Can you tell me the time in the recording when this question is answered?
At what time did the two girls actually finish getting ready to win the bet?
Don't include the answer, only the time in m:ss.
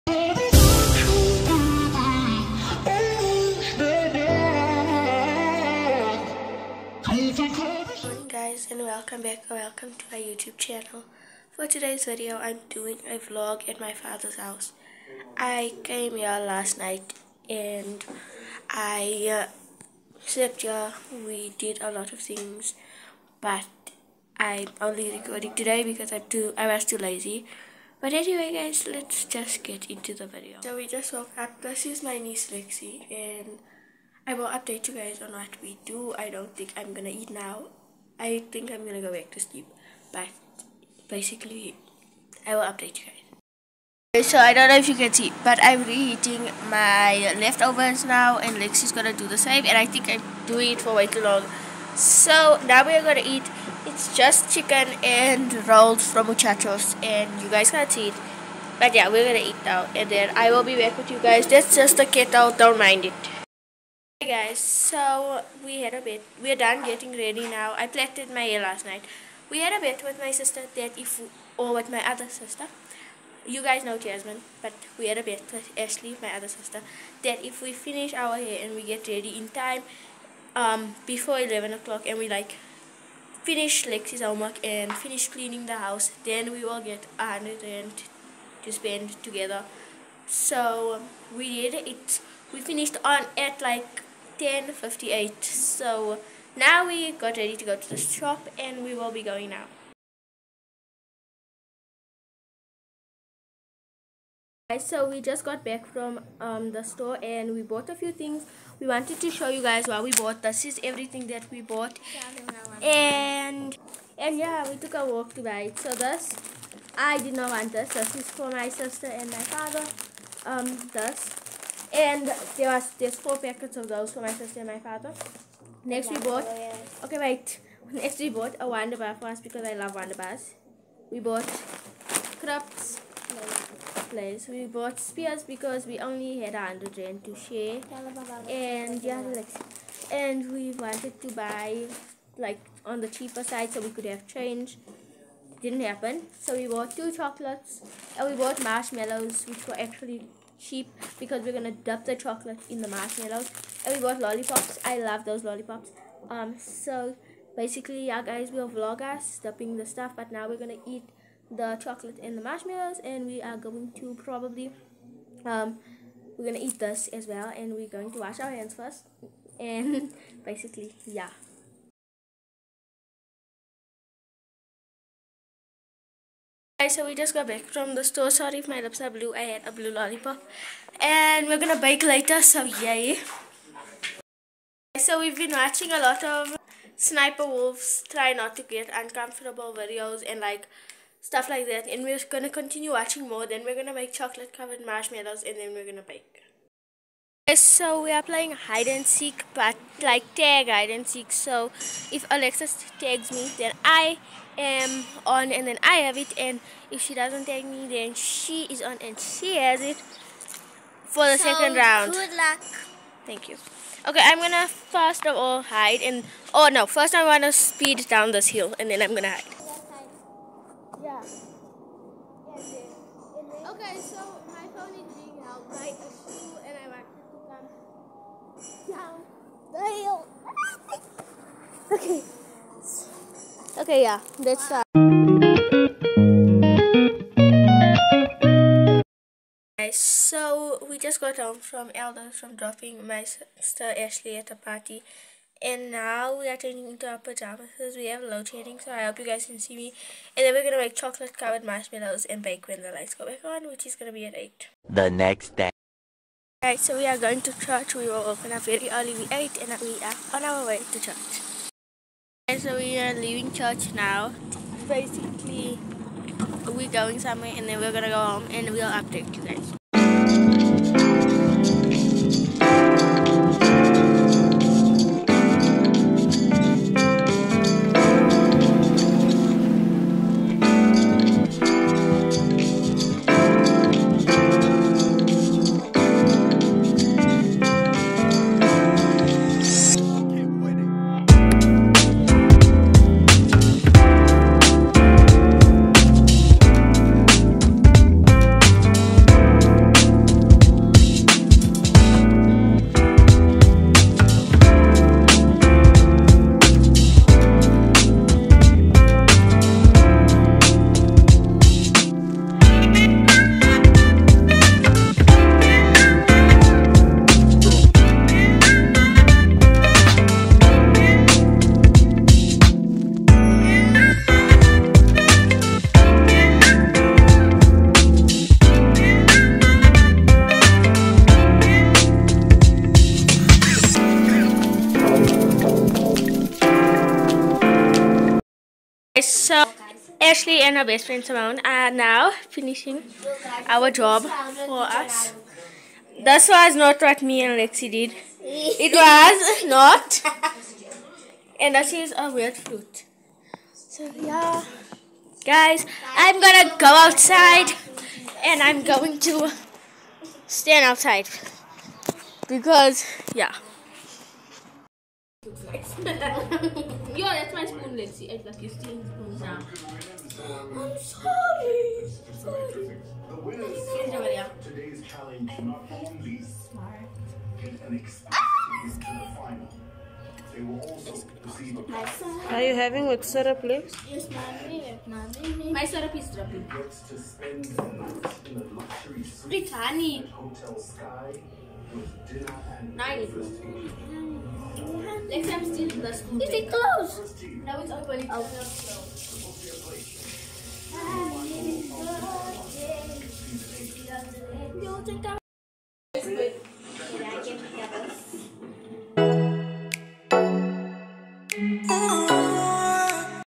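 1:34.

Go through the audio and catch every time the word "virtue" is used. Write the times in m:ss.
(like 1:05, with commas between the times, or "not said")
not said.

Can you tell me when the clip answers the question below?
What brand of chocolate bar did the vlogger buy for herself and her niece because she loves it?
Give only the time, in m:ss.
2:08.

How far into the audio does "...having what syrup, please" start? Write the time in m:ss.
6:22.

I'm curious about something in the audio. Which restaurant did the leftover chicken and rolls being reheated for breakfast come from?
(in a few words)
Muchachos.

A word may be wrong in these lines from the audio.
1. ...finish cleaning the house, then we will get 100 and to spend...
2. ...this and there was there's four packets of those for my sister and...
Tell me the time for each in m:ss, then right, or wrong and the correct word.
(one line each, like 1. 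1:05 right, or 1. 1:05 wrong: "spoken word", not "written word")
1. 1:24 right
2. 2:00 right.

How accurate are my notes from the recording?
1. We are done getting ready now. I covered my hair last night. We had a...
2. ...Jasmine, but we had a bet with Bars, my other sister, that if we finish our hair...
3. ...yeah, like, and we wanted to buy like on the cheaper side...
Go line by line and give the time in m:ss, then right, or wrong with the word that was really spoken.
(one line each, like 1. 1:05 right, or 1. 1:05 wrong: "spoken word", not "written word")
1. 1:06 wrong: "plaited", not "covered"
2. 1:13 wrong: "Ashley", not "Bars"
3. 2:19 right.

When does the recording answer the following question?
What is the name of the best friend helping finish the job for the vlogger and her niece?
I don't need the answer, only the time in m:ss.
5:41.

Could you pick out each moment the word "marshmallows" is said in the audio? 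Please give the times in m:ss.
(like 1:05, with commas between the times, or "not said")
2:28, 2:32, 2:42, 3:14, 4:11.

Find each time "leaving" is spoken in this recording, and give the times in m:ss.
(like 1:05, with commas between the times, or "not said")
4:23.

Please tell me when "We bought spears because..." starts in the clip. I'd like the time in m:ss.
2:14.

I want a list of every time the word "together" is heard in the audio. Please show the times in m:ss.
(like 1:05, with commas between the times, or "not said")
1:29.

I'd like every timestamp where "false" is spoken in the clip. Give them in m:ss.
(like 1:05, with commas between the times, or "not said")
not said.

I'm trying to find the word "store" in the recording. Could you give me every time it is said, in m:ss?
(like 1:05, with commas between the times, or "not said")
1:46, 2:58.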